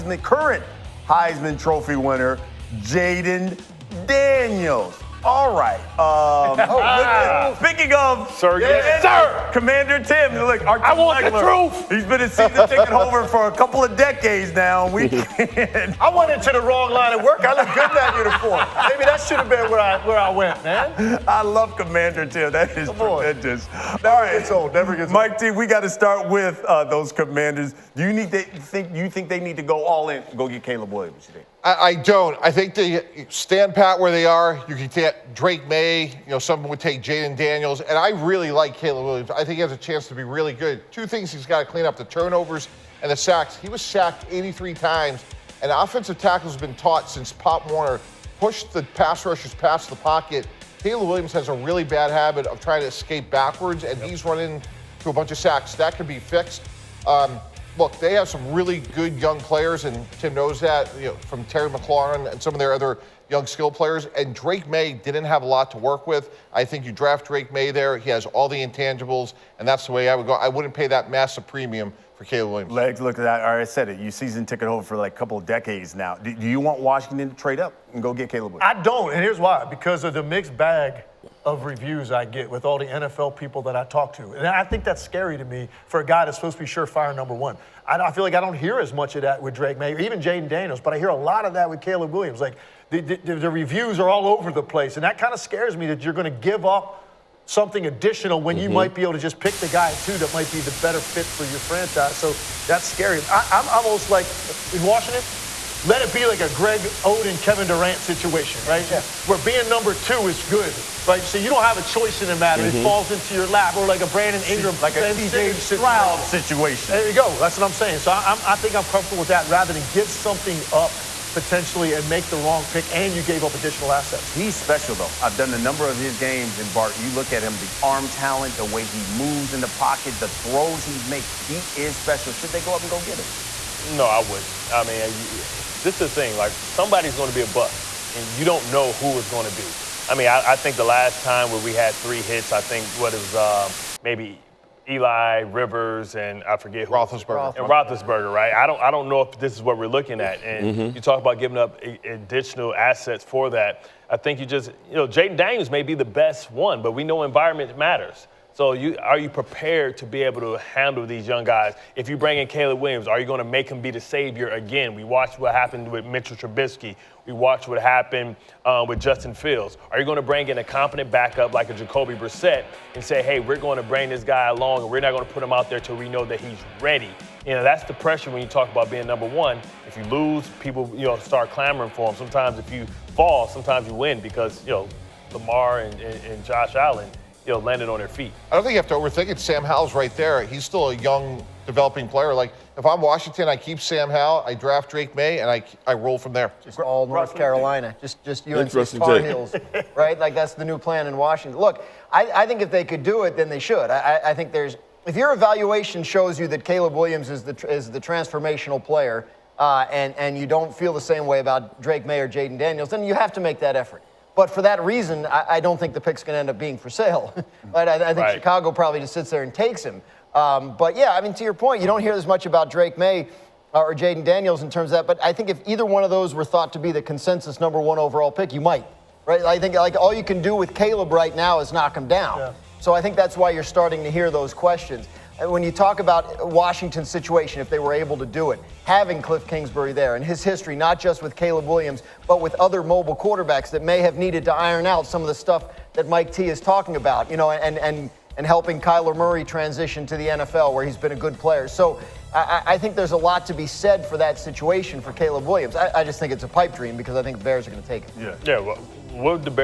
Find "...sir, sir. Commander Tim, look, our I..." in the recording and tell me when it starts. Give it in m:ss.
0:08.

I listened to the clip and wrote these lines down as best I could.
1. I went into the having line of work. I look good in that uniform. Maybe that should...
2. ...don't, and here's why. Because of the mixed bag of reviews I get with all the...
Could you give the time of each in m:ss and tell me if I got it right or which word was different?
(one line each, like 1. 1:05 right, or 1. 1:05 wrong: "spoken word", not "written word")
1. 0:16 wrong: "wrong", not "having"
2. 1:18 right.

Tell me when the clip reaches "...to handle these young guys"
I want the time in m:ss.
2:40.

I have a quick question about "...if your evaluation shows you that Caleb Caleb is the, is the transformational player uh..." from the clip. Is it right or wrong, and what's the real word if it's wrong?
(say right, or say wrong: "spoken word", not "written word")
wrong: "Williams", not "Caleb".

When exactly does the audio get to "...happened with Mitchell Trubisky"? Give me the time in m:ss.
2:45.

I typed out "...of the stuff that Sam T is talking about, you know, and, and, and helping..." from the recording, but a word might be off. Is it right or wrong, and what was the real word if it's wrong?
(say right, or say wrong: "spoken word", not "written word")
wrong: "Mike", not "Sam".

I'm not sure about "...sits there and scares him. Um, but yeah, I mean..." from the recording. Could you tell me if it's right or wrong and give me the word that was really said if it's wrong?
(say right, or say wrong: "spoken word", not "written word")
wrong: "takes", not "scares".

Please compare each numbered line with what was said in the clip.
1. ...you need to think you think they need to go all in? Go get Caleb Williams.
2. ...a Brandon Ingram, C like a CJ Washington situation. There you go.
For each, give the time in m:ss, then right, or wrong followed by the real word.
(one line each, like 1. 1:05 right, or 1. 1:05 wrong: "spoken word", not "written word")
1. 0:28 right
2. 1:54 wrong: "Stroud", not "Washington".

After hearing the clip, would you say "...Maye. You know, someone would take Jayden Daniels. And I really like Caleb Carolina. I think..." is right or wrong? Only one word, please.
wrong.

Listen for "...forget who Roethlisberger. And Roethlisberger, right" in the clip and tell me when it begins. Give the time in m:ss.
2:26.